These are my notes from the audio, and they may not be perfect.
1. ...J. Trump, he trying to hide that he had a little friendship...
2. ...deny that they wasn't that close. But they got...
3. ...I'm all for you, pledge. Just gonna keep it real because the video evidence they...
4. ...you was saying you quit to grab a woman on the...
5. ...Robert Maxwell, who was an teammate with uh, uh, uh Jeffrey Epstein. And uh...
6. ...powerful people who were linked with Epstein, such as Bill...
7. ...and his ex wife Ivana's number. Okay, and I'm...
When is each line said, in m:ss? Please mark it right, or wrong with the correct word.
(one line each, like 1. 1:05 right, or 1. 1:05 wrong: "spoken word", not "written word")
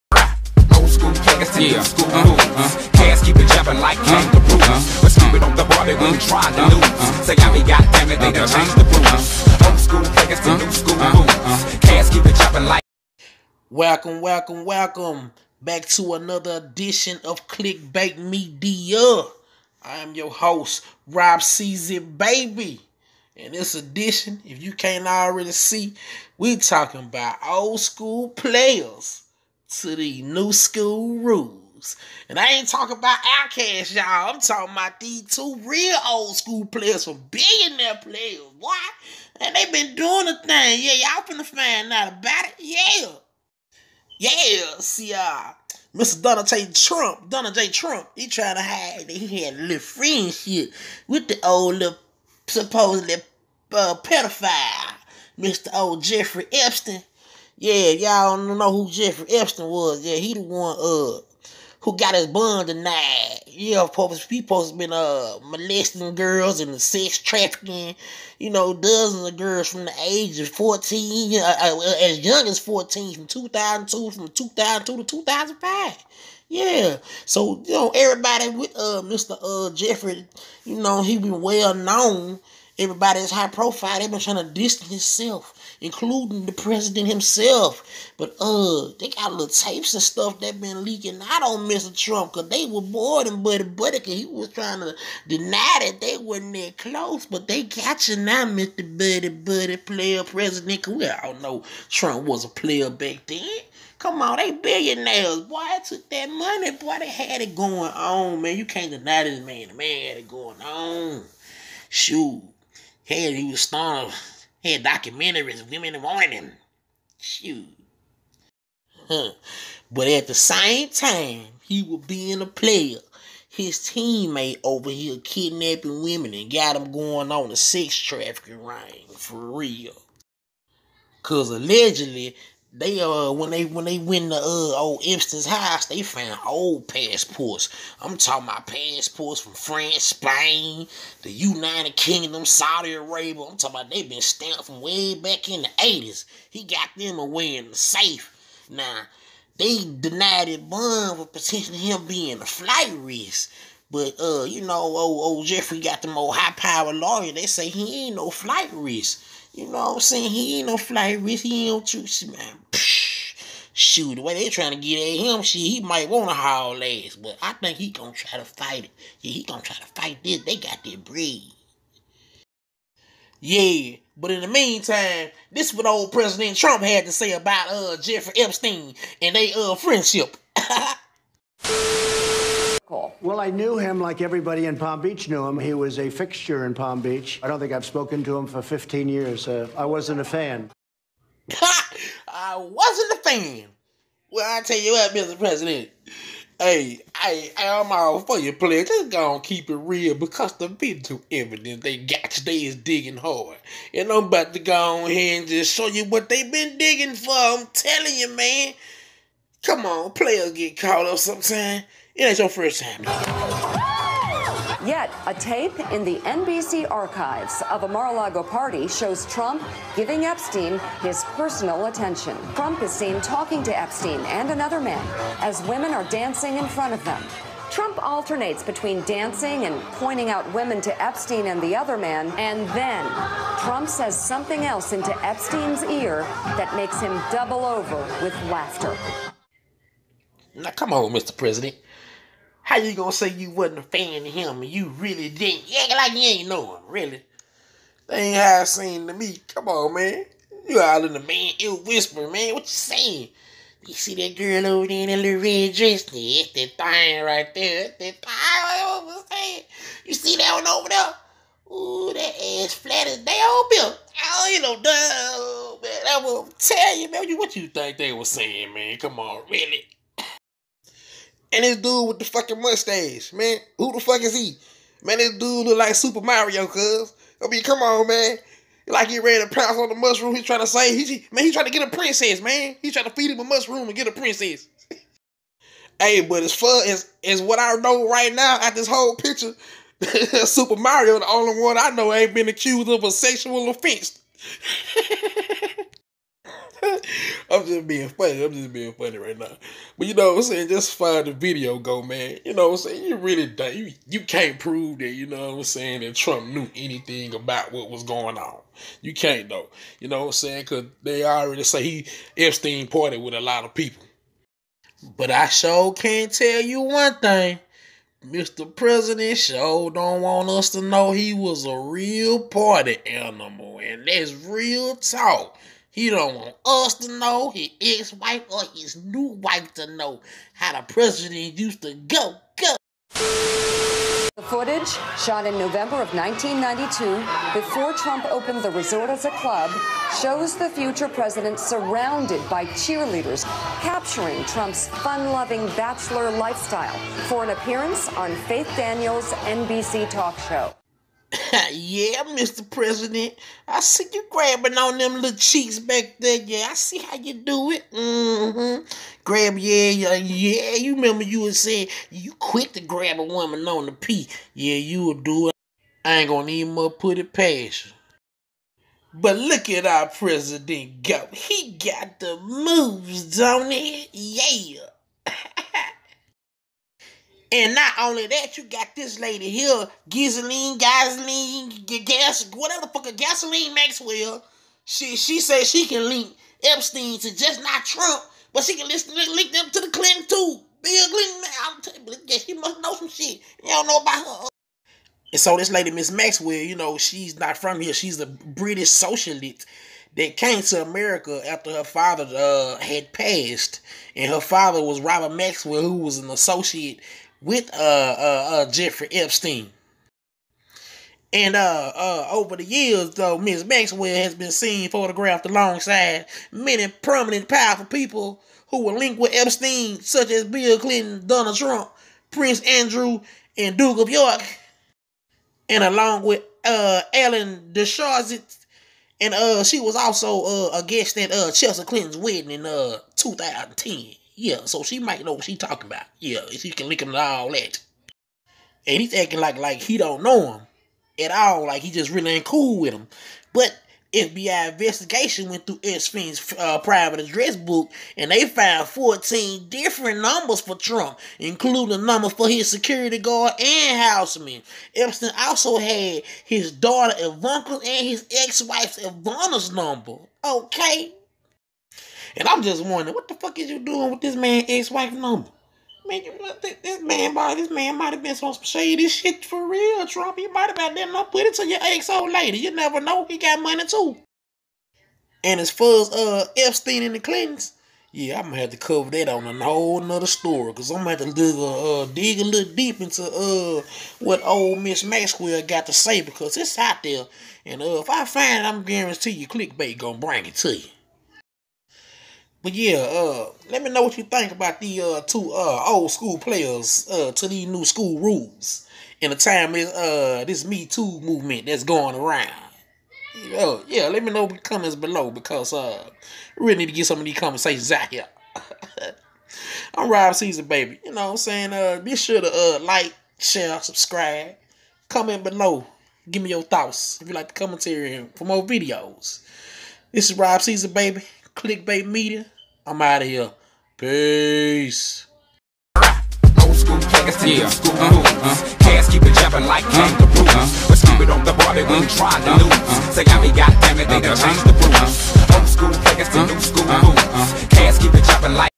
1. 0:47 right
2. 1:35 right
3. 3:17 right
4. 6:01 right
5. 6:45 wrong: "associate", not "teammate"
6. 6:57 right
7. 7:37 right.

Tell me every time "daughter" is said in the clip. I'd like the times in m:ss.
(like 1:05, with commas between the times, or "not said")
7:36.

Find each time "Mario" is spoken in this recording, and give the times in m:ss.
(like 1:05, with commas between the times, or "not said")
4:36, 4:50.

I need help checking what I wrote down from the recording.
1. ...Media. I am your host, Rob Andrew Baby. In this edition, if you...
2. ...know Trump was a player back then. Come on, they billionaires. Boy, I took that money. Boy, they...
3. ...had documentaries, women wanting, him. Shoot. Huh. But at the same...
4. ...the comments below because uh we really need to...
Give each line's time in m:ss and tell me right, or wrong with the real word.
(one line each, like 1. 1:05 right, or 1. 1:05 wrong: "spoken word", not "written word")
1. 0:18 wrong: "Season", not "Andrew"
2. 1:41 right
3. 1:54 right
4. 8:24 right.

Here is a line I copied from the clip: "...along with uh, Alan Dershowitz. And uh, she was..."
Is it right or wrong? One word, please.
right.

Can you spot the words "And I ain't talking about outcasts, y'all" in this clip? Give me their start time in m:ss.
0:32.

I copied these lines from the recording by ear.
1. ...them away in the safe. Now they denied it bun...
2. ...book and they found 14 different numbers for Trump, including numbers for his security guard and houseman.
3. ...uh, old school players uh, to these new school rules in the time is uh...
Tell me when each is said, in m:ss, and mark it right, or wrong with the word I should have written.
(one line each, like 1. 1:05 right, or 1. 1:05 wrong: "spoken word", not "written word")
1. 2:26 right
2. 7:27 right
3. 8:15 right.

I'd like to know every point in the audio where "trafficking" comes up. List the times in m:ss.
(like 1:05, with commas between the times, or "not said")
1:07, 2:07.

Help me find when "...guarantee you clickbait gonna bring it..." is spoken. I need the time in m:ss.
8:08.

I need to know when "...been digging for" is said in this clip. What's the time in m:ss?
3:26.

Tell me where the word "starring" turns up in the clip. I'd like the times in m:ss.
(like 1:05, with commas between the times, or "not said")
1:53.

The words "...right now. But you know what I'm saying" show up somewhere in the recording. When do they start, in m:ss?
4:59.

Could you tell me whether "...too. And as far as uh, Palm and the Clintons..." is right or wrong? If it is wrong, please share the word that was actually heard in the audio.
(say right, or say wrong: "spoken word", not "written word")
wrong: "Epstein", not "Palm".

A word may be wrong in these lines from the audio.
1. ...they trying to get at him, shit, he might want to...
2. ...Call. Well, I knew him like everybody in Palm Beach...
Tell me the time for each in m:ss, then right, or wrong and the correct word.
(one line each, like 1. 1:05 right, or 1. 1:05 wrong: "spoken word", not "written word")
1. 2:44 right
2. 3:02 right.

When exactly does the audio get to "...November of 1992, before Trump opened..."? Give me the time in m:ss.
5:35.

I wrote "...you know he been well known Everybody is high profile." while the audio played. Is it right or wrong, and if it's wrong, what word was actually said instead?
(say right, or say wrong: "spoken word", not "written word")
right.